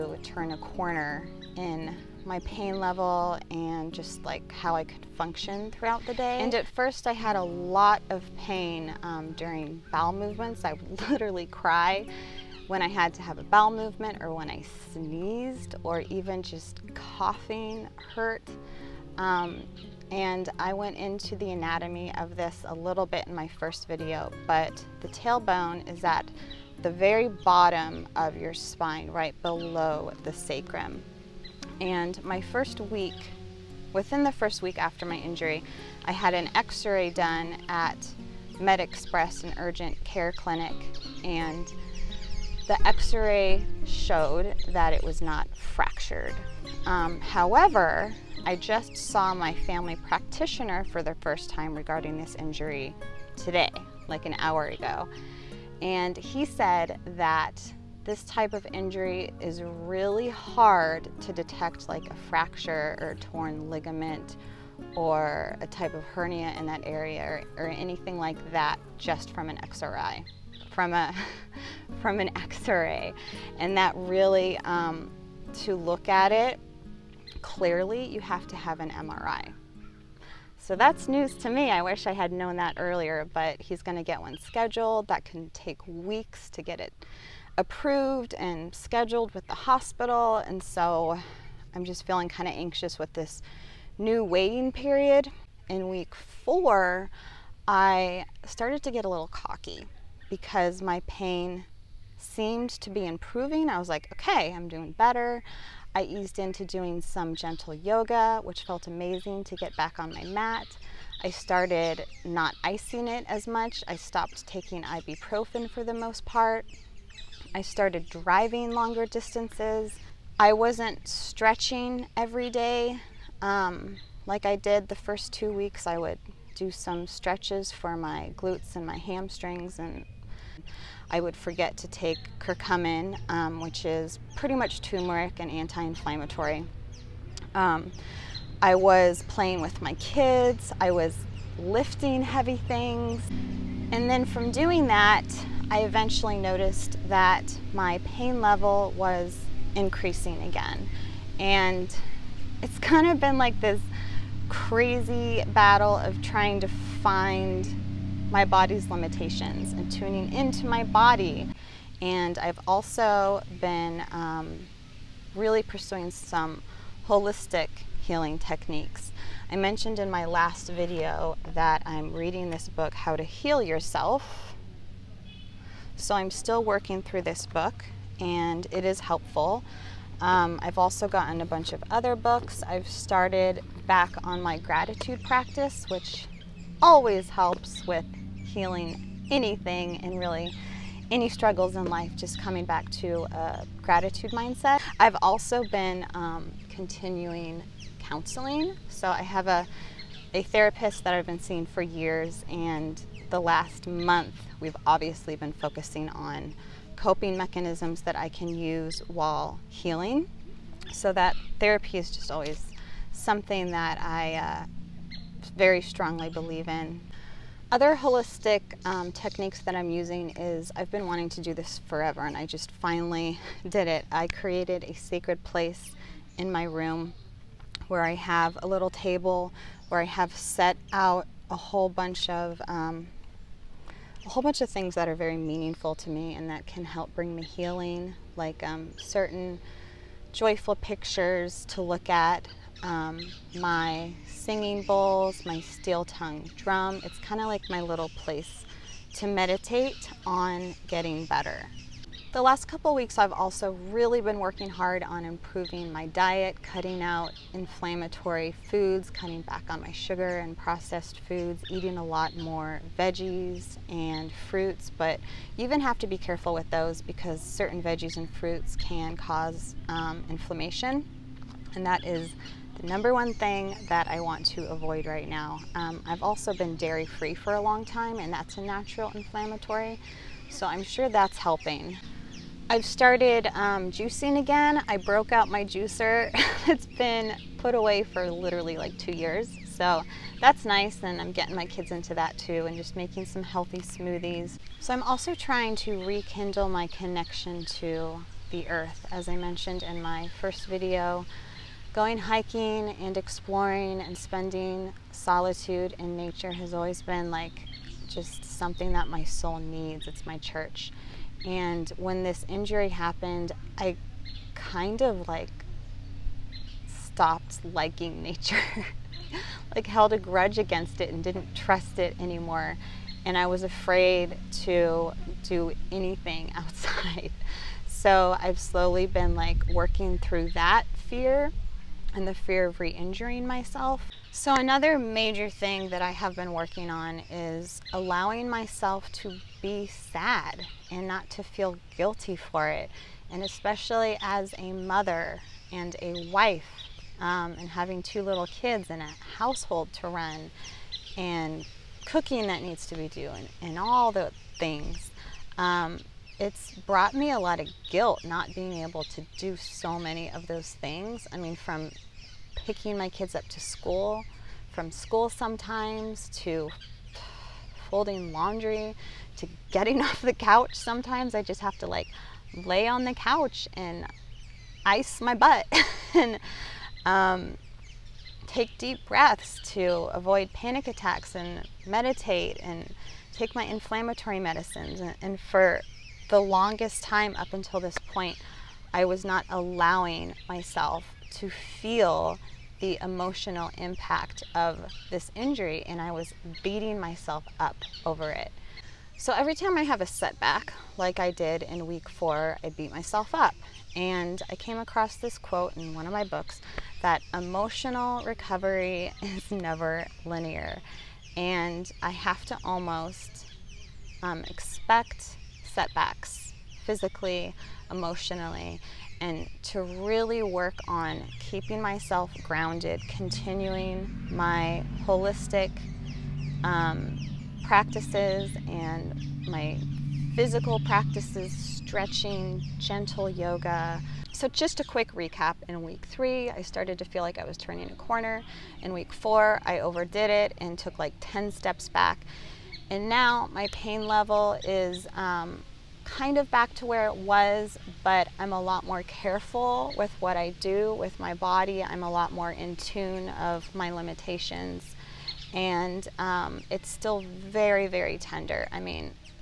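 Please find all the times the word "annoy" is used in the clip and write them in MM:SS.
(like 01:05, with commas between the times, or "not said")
not said.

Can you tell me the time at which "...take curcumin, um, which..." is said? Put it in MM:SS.
02:11.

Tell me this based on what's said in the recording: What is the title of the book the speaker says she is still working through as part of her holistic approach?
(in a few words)
How to Heal Yourself.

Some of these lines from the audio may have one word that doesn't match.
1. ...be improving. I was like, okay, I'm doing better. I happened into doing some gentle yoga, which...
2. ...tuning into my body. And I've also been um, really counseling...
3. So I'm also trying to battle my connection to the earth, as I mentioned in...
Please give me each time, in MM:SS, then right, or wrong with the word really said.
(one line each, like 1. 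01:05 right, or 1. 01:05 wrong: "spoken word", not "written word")
1. 01:42 wrong: "eased", not "happened"
2. 02:39 wrong: "pursuing", not "counseling"
3. 04:54 wrong: "rekindle", not "battle".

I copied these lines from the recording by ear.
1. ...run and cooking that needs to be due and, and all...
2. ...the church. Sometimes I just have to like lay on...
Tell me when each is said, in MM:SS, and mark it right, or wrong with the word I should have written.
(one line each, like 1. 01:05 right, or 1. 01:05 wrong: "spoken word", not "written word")
1. 05:50 right
2. 06:10 wrong: "couch", not "church".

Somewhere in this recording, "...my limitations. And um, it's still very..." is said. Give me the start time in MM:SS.
07:33.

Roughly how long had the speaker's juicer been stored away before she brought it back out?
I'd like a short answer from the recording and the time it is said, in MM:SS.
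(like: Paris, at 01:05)
2 years, at 04:48.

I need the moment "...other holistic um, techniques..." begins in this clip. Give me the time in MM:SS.
03:37.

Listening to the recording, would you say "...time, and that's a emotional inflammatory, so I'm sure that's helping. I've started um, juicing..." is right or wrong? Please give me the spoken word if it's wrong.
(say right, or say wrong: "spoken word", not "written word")
wrong: "natural", not "emotional".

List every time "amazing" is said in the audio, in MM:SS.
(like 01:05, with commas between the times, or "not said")
01:48.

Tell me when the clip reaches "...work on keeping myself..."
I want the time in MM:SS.
07:00.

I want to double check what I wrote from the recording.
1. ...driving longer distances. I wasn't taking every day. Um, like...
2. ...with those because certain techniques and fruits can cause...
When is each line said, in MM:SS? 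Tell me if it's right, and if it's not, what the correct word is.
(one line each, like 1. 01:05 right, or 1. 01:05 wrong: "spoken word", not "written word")
1. 01:58 wrong: "stretching", not "taking"
2. 04:26 wrong: "veggies", not "techniques".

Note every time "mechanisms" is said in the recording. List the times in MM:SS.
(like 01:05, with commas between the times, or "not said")
03:27.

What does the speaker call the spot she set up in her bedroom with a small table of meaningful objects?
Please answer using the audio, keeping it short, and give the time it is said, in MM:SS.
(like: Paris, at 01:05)
Sacred place, at 03:44.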